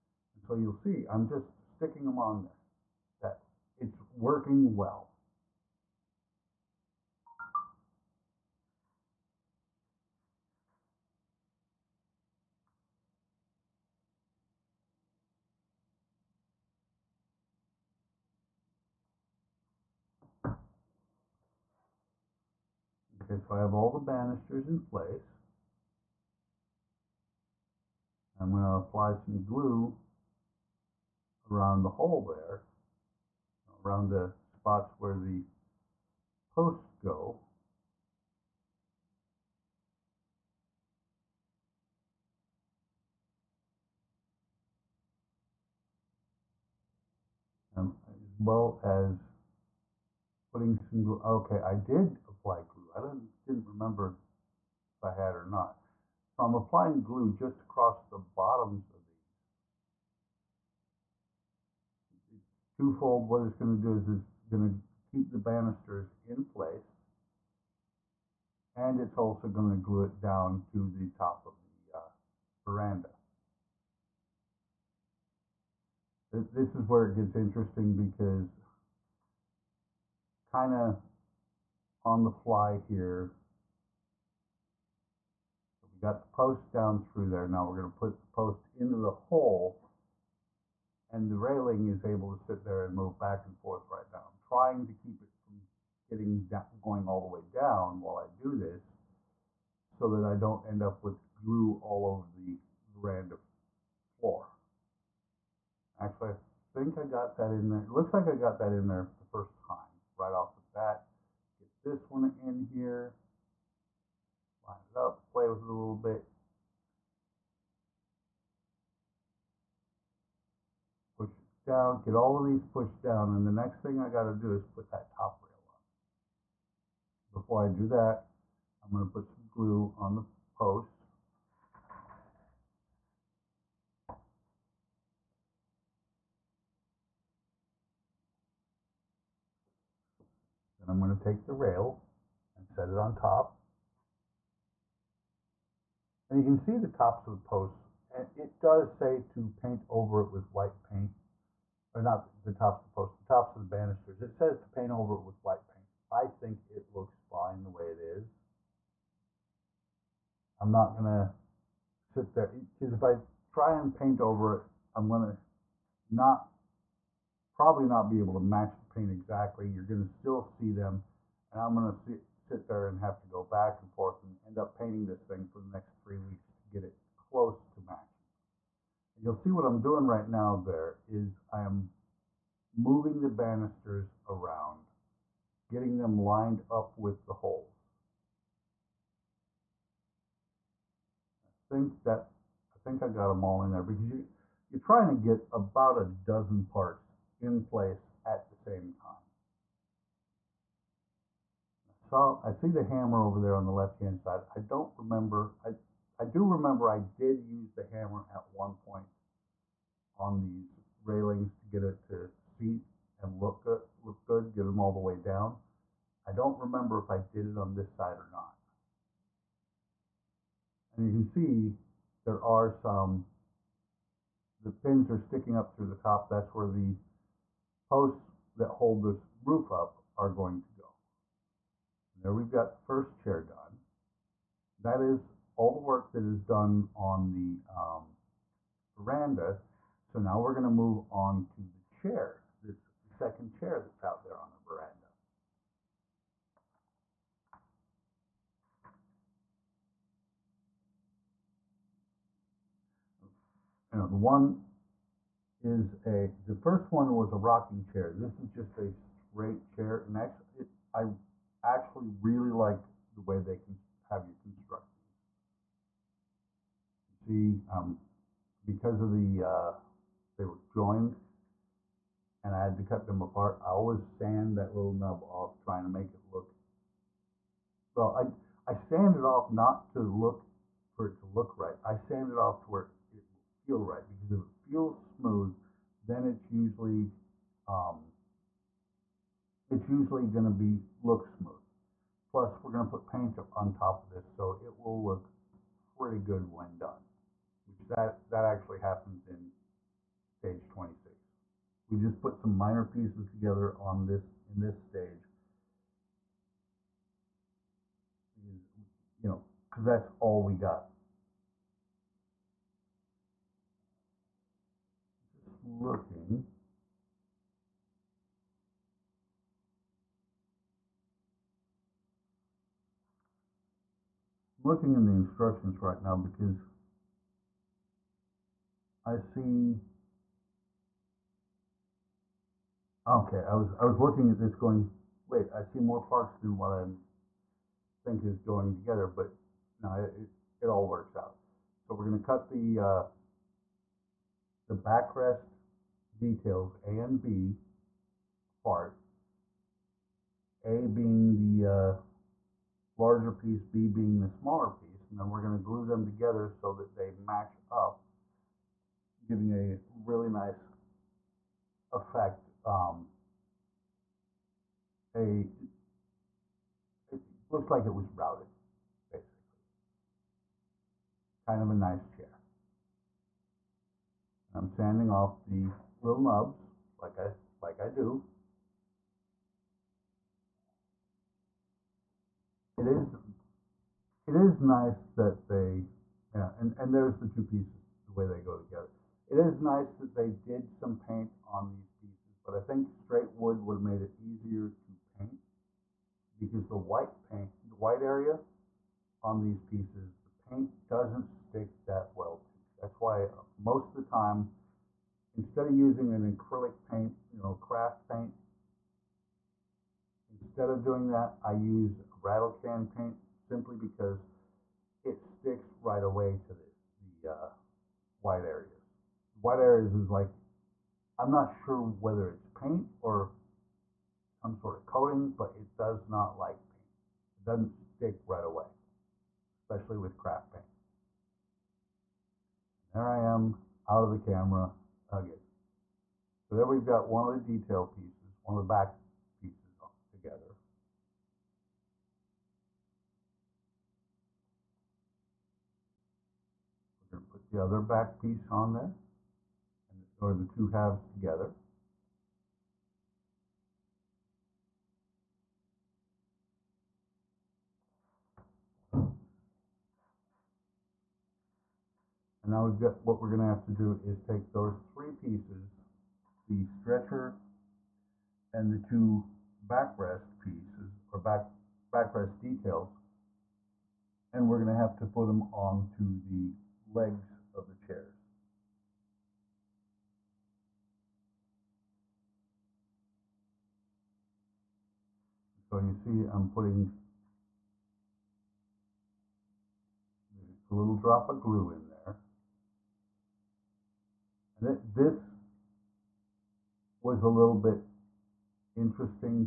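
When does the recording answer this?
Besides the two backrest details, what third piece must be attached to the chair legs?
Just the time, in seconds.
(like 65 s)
466 s.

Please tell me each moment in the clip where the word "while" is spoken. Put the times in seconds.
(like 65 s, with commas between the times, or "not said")
97 s.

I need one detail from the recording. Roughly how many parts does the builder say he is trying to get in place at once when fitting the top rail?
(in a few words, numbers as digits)
About a dozen.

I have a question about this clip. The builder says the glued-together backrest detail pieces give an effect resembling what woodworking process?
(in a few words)
Routed.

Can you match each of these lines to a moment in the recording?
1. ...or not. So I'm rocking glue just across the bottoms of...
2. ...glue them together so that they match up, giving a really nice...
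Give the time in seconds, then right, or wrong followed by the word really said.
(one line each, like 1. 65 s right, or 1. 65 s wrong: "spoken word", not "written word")
1. 55 s wrong: "applying", not "rocking"
2. 355 s right.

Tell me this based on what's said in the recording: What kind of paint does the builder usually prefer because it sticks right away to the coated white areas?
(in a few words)
Rattle can paint.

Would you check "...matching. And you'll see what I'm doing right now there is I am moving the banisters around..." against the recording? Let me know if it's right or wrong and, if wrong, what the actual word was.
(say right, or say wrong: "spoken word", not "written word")
right.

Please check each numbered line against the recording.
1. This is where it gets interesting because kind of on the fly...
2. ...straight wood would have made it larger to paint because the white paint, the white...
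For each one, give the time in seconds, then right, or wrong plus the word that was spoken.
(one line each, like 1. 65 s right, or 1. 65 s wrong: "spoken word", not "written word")
1. 76 s right
2. 392 s wrong: "easier", not "larger".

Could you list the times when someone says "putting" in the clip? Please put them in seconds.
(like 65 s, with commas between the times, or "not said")
50 s, 486 s.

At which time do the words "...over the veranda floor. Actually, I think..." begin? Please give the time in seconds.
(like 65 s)
102 s.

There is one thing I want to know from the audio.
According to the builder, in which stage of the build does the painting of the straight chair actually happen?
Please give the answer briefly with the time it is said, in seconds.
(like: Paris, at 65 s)
Stage 26, at 300 s.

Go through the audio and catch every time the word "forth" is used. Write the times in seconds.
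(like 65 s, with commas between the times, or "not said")
93 s, 173 s.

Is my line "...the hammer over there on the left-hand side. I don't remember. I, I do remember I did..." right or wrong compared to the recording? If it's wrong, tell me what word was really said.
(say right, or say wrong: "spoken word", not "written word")
right.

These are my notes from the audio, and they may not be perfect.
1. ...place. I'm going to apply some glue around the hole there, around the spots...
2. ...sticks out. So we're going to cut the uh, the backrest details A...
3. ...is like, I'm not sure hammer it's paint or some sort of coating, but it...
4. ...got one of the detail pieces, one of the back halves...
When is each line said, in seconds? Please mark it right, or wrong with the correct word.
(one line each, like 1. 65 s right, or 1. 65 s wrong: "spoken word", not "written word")
1. 24 s right
2. 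340 s wrong: "works", not "sticks"
3. 419 s wrong: "whether", not "hammer"
4. 436 s wrong: "pieces", not "halves".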